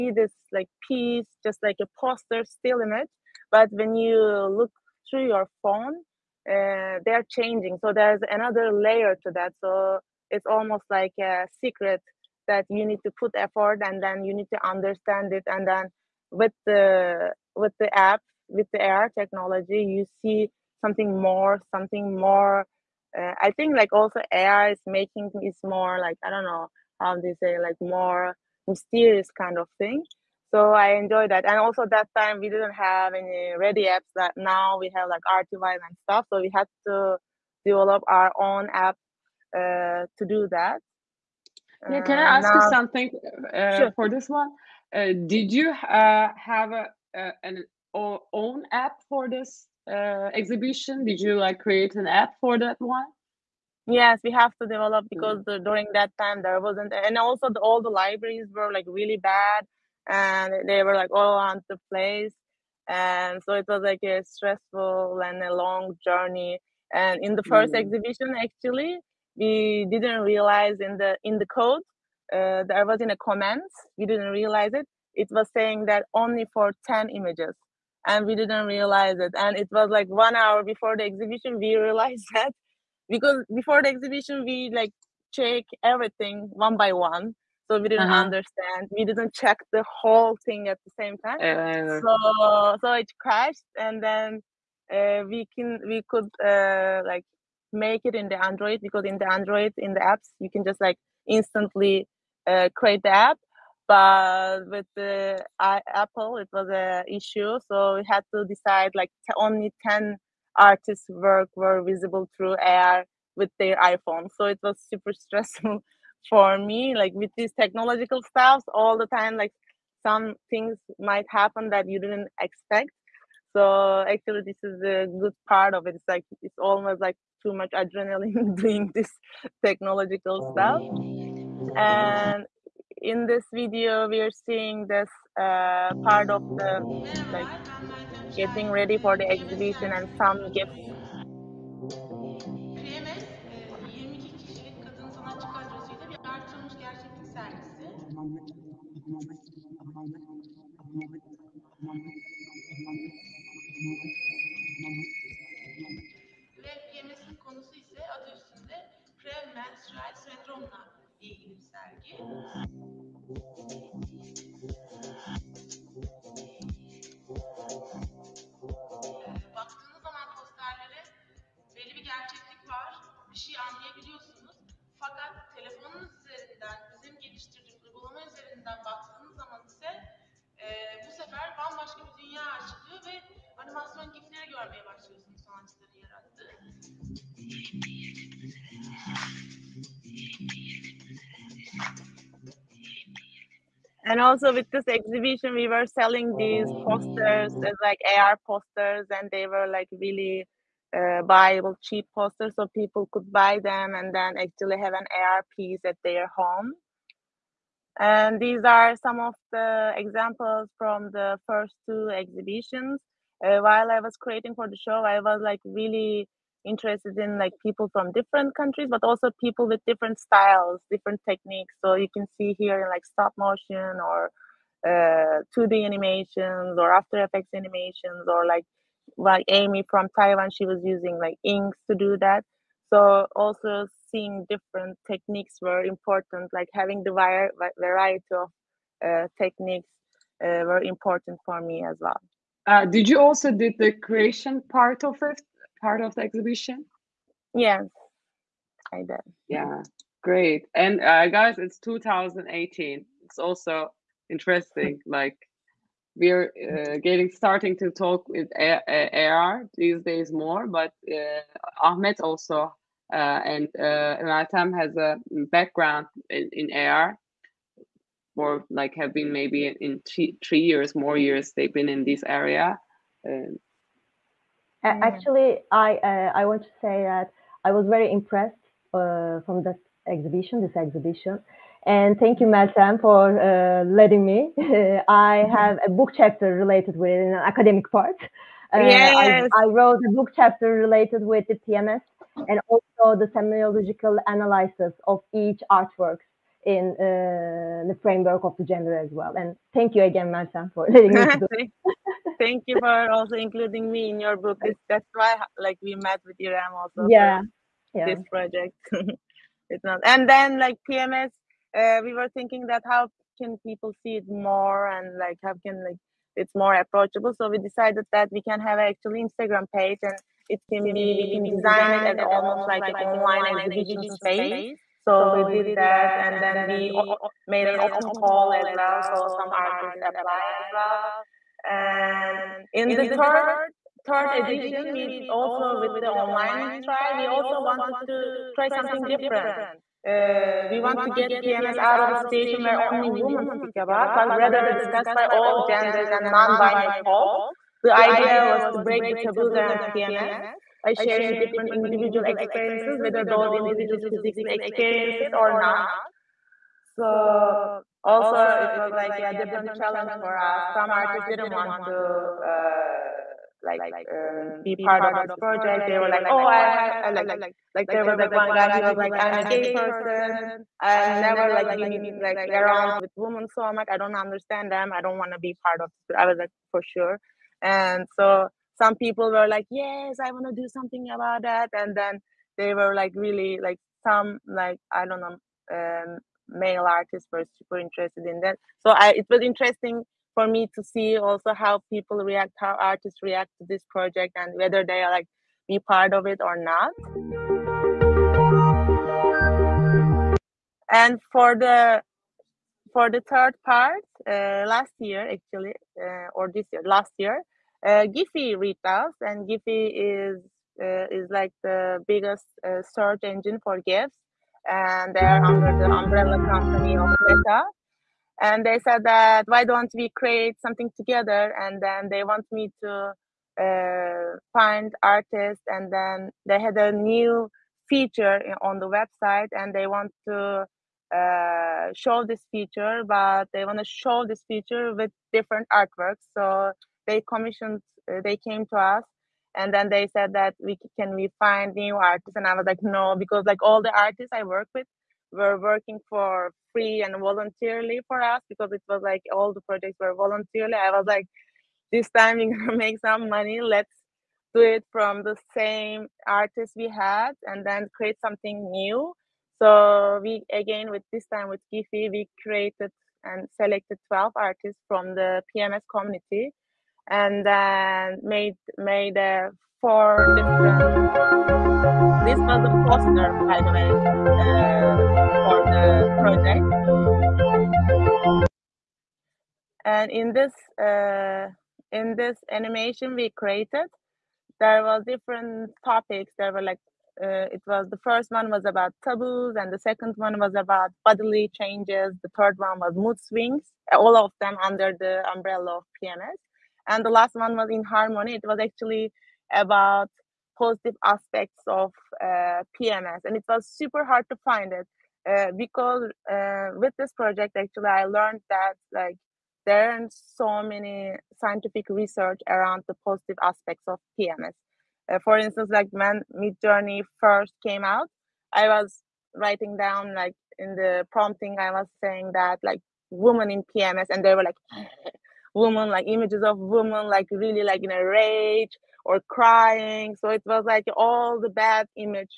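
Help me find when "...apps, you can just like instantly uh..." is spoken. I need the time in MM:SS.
01:40.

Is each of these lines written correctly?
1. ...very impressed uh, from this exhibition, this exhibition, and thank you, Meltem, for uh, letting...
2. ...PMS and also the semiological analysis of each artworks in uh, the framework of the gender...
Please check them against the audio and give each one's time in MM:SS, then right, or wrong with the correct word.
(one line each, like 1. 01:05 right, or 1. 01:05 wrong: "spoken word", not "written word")
1. 04:37 right
2. 04:51 right.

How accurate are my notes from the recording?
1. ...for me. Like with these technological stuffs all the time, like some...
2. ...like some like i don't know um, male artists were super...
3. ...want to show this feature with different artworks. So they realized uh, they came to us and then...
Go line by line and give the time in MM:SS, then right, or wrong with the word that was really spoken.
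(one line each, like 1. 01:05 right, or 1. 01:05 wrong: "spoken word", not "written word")
1. 01:56 right
2. 06:23 right
3. 07:13 wrong: "commissioned", not "realized".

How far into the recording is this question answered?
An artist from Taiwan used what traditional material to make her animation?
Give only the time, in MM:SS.
03:51.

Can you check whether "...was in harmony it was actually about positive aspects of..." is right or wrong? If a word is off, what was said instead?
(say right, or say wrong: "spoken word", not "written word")
right.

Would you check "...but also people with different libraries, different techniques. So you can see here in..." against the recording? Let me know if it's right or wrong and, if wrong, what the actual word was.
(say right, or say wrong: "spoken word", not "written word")
wrong: "styles", not "libraries".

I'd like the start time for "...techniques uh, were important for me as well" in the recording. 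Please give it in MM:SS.
03:59.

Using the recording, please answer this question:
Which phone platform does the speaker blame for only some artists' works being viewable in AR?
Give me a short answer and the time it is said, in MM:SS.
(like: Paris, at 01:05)
Apple, at 01:45.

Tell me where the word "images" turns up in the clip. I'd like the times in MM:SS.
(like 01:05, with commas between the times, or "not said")
00:02, 01:17, 08:46.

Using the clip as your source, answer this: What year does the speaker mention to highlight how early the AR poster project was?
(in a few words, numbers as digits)
2018.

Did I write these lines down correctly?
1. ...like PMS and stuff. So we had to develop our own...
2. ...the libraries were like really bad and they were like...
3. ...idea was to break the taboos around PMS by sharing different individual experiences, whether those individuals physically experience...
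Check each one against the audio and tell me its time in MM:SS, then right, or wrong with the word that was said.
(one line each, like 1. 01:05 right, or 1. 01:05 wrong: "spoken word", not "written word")
1. 00:35 wrong: "Artivive", not "PMS"
2. 00:57 right
3. 05:47 right.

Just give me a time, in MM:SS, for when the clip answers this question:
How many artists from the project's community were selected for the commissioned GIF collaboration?
07:44.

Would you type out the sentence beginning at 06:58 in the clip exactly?
And they said that why don't we create something together?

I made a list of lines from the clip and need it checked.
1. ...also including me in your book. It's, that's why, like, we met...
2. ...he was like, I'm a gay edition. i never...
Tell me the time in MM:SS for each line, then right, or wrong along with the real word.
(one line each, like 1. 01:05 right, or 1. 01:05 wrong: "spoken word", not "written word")
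1. 05:03 right
2. 06:08 wrong: "person", not "edition".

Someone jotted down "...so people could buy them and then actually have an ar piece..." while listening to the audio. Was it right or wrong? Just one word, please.
right.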